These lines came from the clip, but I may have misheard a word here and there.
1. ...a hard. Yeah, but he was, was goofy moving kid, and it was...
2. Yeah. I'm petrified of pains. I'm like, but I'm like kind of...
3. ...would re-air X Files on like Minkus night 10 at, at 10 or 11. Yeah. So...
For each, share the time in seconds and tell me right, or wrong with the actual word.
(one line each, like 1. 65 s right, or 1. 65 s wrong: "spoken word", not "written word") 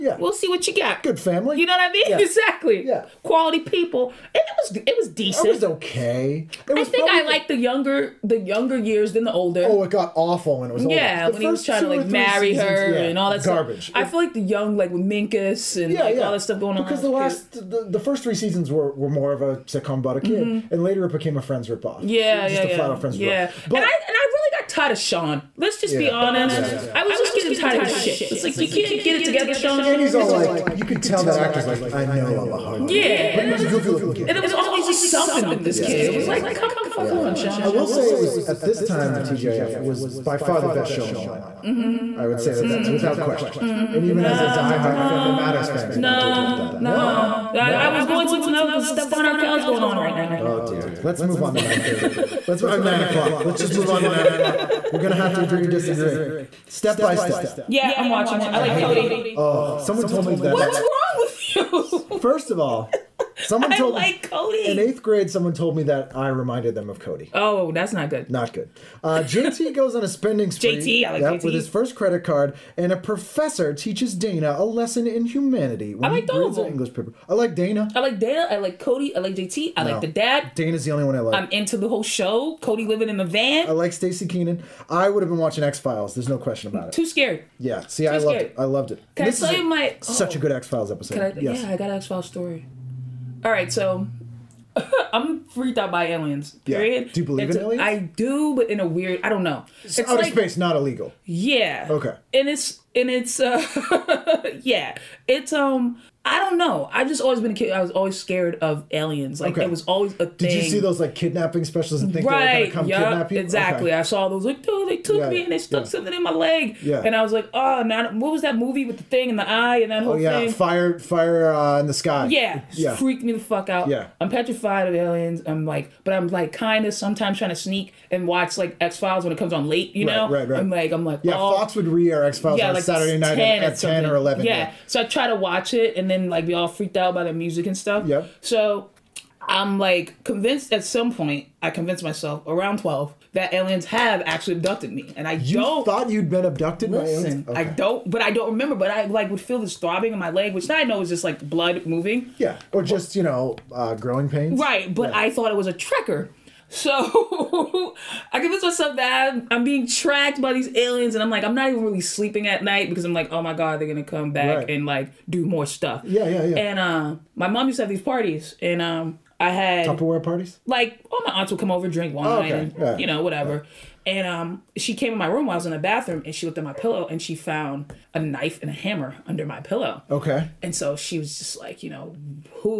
1. 32 s wrong: "looking", not "moving"
2. 123 s wrong: "aliens", not "pains"
3. 131 s wrong: "Saturday", not "Minkus".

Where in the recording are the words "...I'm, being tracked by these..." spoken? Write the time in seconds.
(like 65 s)
159 s.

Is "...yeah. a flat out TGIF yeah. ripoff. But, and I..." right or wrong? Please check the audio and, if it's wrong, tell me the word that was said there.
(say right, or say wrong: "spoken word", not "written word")
wrong: "Friends", not "TGIF".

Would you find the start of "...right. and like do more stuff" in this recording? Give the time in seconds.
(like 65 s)
164 s.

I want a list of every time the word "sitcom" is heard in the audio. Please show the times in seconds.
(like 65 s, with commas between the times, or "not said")
19 s.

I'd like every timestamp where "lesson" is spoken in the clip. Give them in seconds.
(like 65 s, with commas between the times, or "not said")
74 s.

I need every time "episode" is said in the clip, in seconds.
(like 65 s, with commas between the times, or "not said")
90 s.